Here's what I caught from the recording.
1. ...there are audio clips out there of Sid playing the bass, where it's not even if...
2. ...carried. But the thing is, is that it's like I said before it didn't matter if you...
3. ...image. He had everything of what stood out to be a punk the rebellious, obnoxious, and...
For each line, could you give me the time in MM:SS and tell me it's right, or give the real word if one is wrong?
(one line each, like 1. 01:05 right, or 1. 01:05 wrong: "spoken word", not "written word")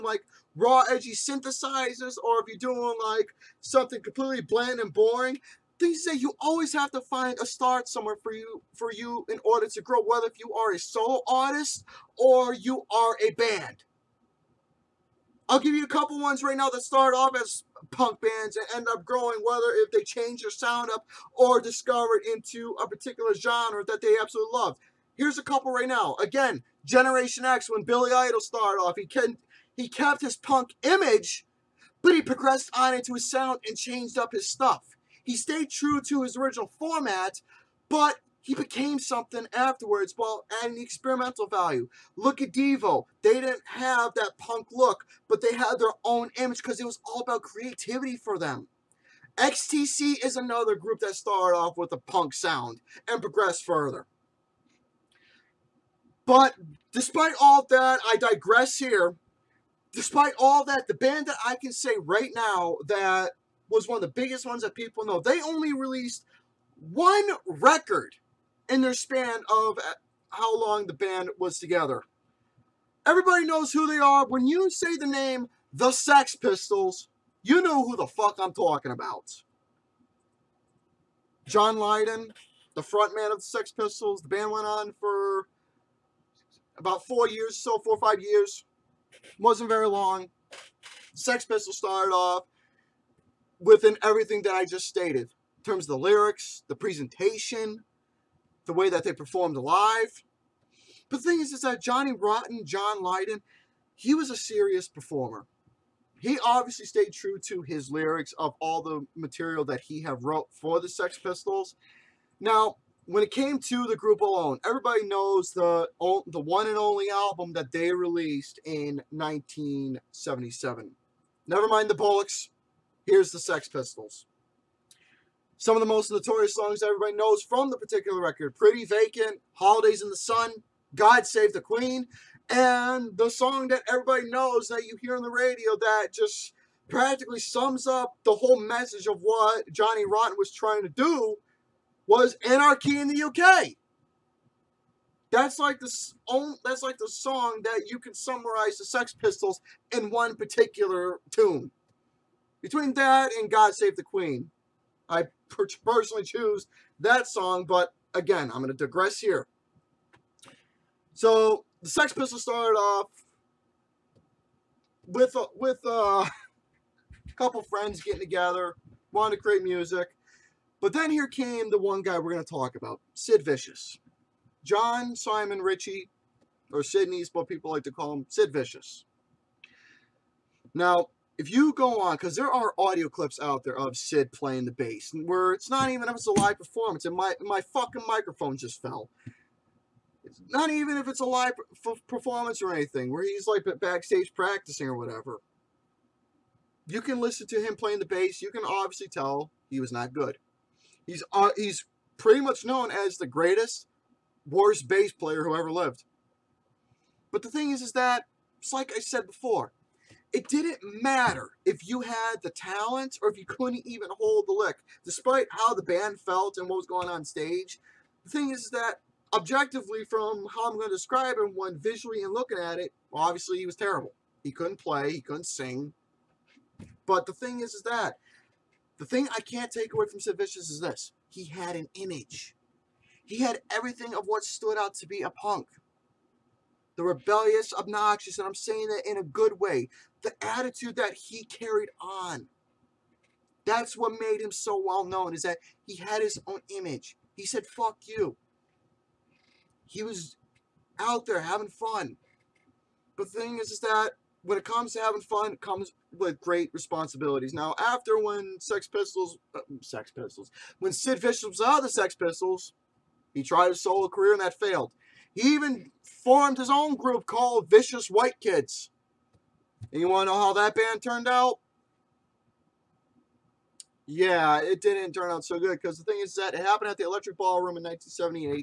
1. 03:02 right
2. 03:25 wrong: "lived", not "carried"
3. 03:51 right.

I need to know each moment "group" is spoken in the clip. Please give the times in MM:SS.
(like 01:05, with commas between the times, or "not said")
00:50, 01:53, 04:26.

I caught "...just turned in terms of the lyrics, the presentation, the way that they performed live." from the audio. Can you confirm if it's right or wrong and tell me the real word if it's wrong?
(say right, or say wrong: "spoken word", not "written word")
wrong: "stated", not "turned".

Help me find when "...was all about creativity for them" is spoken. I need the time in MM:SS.
00:46.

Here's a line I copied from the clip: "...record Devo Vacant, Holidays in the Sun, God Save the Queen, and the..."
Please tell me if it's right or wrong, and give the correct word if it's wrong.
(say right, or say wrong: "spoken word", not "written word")
wrong: "Pretty", not "Devo".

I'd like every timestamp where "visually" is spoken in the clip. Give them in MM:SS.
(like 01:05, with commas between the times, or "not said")
03:41.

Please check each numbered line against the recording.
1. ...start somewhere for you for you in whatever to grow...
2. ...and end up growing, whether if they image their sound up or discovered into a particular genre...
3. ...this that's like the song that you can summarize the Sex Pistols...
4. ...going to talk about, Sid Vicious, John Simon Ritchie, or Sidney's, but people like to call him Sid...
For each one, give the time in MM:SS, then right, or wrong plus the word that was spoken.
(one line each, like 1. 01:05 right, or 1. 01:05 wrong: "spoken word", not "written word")
1. 00:07 wrong: "order", not "whatever"
2. 00:18 wrong: "change", not "image"
3. 02:25 right
4. 02:52 right.